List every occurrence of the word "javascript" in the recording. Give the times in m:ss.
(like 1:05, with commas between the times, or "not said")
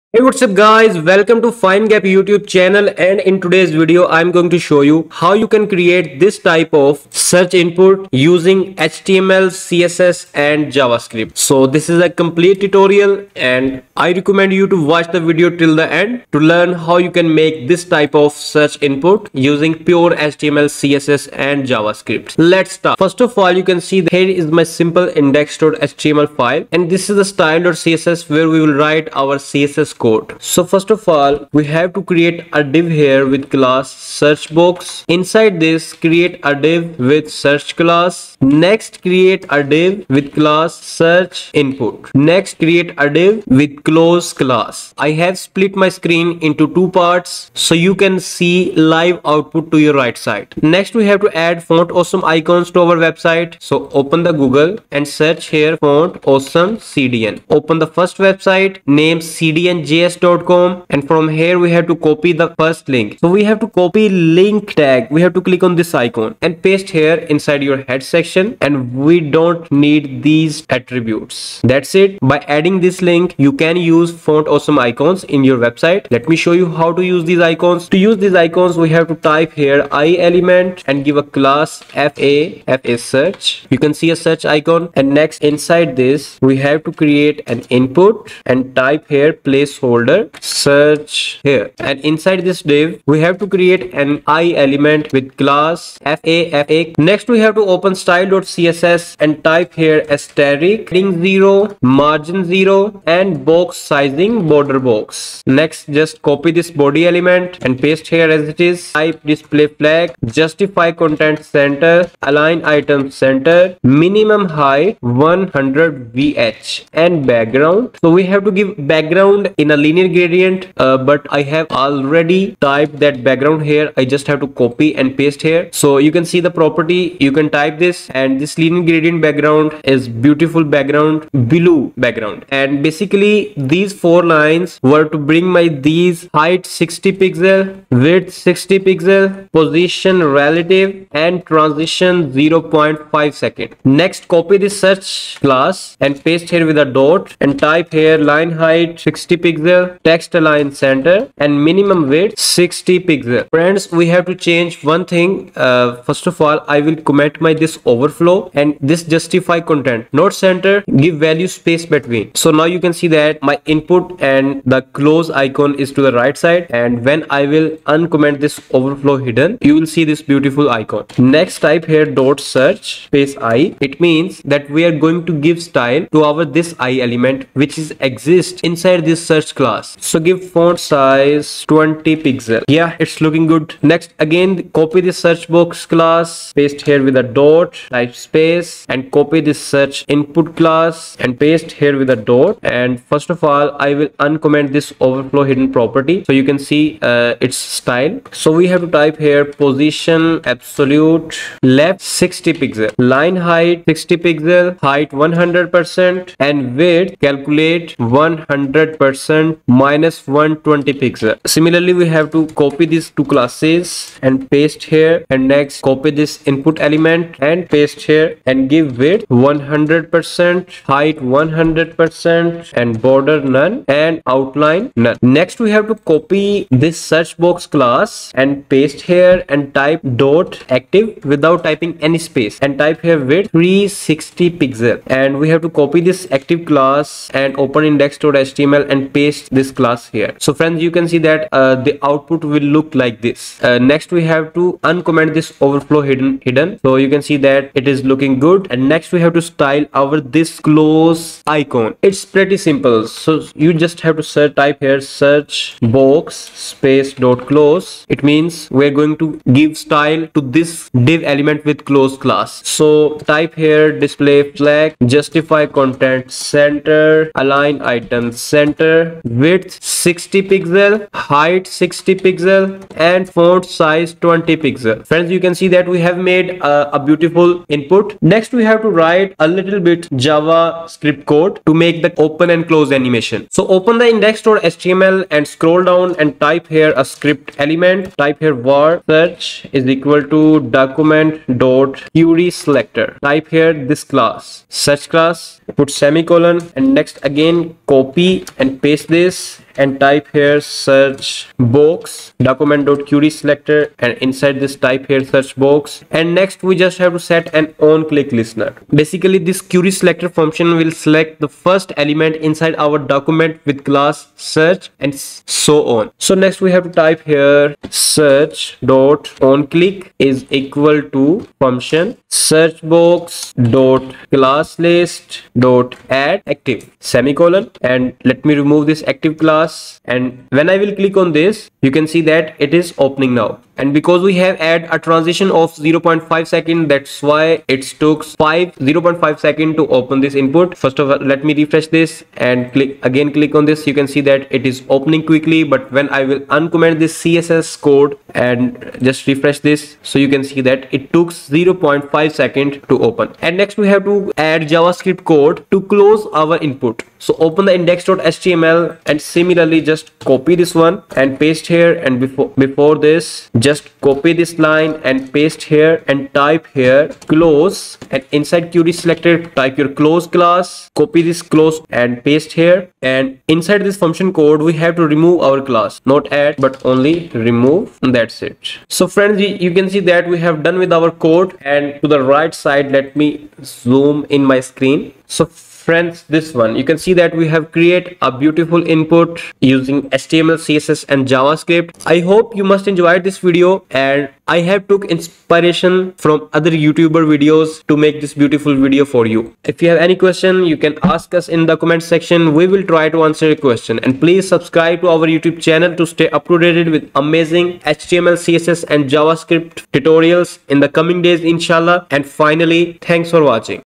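0:10, 0:21, 4:40, 5:54, 6:31, 6:49.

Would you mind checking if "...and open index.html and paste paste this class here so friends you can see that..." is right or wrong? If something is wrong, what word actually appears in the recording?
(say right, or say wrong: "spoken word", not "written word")
right.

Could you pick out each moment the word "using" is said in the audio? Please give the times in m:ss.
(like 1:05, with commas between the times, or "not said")
0:08, 0:19, 6:29.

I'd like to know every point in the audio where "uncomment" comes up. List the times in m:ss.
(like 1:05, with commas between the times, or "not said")
2:47, 3:14, 4:04, 5:46.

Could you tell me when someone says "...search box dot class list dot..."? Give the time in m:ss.
5:22.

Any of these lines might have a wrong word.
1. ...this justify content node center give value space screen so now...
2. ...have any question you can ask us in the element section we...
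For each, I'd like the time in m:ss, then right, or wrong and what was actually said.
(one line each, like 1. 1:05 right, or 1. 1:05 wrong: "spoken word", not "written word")
1. 2:38 wrong: "between", not "screen"
2. 6:39 wrong: "comment", not "element".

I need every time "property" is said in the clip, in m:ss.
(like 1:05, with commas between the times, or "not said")
2:06, 3:15.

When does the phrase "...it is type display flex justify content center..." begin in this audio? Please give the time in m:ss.
1:48.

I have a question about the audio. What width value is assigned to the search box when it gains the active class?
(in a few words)
360 pixels.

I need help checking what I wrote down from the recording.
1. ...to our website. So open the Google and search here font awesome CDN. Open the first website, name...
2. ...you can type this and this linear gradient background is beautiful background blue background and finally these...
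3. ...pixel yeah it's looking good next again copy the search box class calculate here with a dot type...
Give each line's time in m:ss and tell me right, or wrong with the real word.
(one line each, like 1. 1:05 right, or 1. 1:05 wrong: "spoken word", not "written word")
1. 0:52 right
2. 2:07 wrong: "basically", not "finally"
3. 3:02 wrong: "paste", not "calculate".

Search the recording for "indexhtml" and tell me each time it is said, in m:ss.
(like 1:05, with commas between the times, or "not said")
0:25, 3:57, 4:44, 5:57.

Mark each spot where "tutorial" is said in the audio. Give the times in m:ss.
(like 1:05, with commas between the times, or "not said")
0:12, 6:49.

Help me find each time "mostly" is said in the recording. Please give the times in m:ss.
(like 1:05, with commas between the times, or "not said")
not said.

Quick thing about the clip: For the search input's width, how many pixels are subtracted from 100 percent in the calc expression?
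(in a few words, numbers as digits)
120 pixels.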